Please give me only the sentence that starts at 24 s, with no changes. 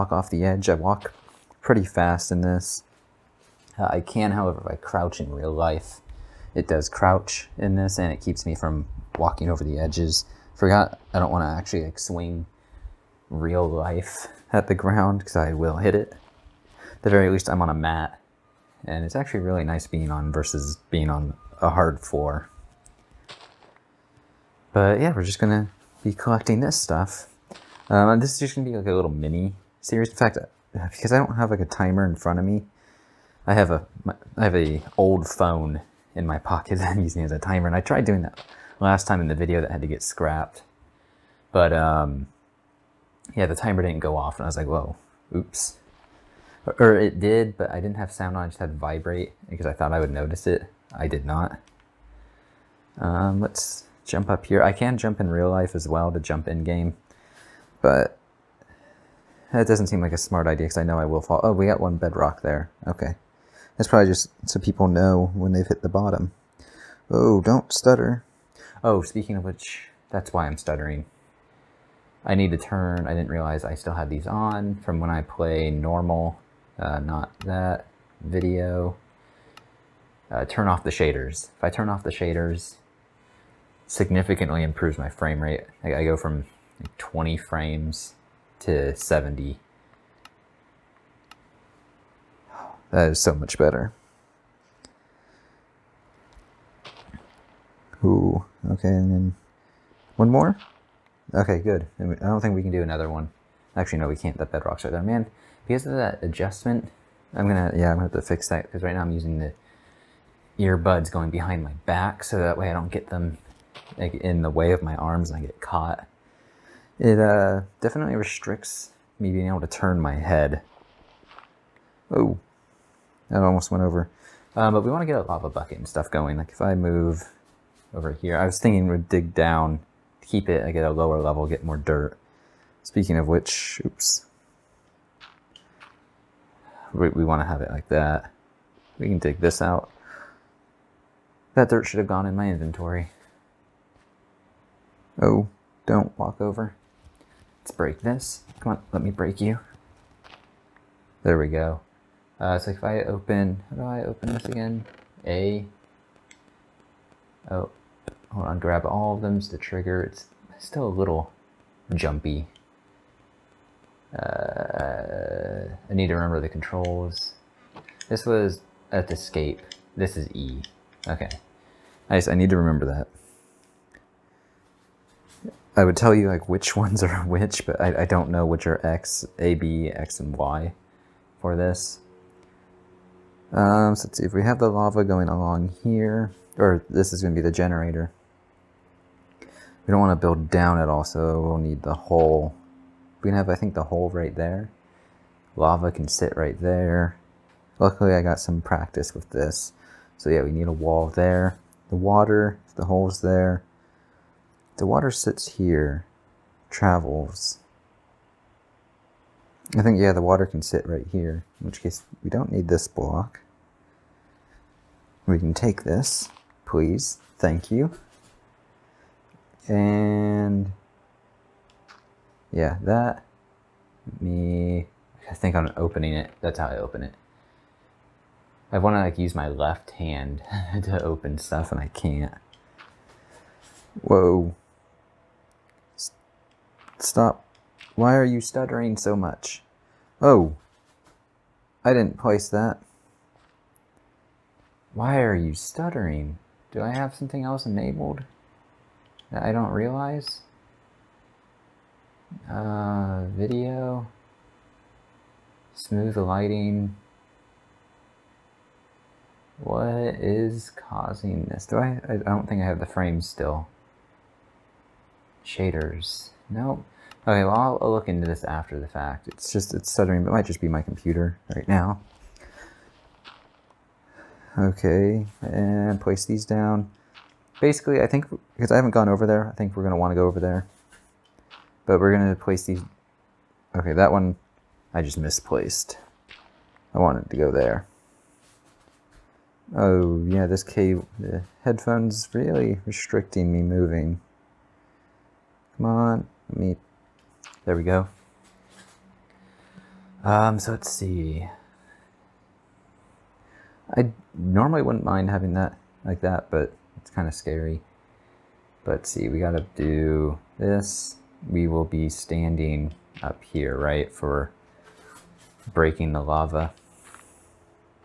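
But yeah, we're just gonna be collecting this stuff.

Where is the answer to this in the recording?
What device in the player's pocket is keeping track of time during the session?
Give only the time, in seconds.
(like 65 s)
34 s.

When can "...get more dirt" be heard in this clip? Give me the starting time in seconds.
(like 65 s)
131 s.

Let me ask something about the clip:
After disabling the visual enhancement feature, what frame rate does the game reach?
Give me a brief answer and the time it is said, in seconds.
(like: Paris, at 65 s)
70, at 88 s.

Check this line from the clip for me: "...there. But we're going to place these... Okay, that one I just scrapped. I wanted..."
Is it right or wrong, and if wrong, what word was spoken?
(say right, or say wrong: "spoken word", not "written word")
wrong: "misplaced", not "scrapped".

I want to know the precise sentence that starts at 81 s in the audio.
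If I turn off the shaders, significantly improves my frame rate.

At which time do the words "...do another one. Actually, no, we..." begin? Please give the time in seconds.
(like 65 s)
102 s.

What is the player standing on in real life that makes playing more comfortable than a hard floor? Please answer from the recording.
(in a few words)
a mat.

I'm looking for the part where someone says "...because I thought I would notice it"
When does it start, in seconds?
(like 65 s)
49 s.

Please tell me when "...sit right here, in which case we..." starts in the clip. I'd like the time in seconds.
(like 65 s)
210 s.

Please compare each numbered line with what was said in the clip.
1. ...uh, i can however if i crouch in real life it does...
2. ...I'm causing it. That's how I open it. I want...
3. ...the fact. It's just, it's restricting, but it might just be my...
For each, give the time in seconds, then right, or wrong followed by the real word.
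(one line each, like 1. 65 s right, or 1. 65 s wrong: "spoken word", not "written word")
1. 3 s right
2. 225 s wrong: "opening", not "causing"
3. 268 s wrong: "stuttering", not "restricting".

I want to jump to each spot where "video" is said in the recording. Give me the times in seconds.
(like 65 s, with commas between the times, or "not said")
39 s, 78 s, 253 s.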